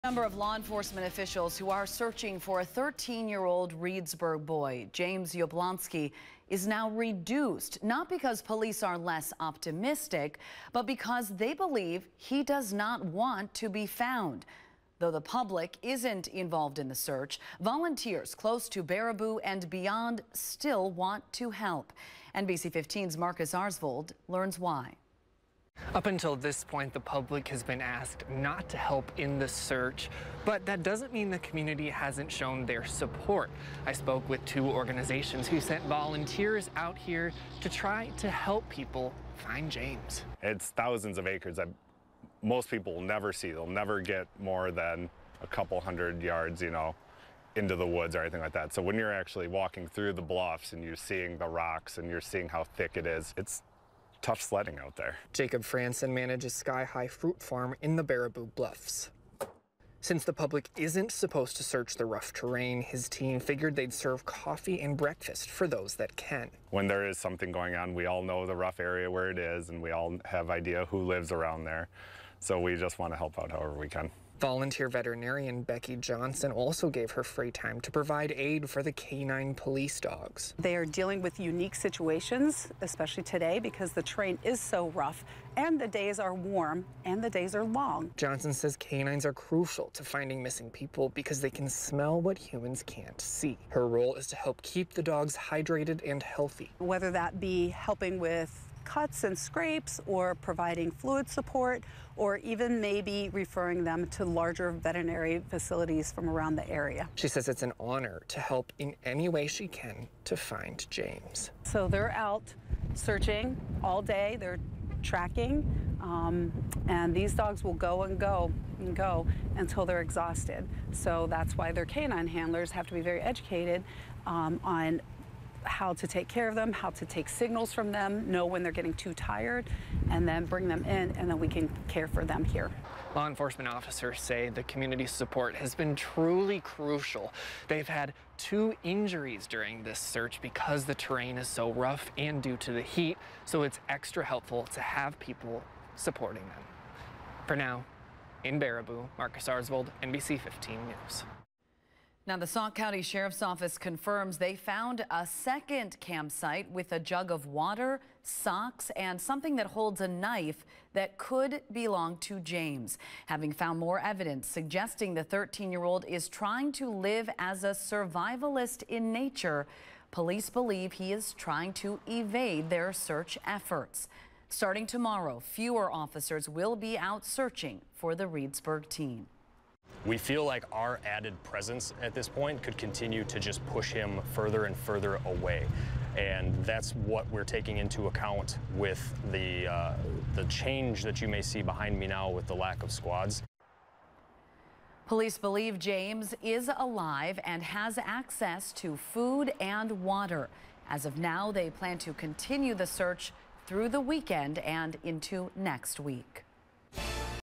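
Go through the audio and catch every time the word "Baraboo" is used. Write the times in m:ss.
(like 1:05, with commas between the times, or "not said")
0:18, 0:58, 2:28.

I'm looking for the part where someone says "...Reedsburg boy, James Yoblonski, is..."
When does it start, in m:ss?
0:03.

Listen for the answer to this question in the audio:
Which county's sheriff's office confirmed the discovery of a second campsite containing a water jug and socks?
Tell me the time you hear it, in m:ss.
2:32.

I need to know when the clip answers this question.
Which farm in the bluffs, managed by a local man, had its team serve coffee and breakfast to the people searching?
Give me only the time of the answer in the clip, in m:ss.
0:56.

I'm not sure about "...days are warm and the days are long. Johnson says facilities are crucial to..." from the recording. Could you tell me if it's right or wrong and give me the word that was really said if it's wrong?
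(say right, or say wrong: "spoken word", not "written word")
wrong: "canines", not "facilities".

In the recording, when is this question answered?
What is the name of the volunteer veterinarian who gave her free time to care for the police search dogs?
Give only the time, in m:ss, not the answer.
1:15.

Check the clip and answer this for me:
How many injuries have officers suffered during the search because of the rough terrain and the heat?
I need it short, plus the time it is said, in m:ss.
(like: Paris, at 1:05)
2, at 2:18.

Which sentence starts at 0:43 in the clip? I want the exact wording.
They'll never get more than a couple hundred yards, you know, into the woods or anything like that.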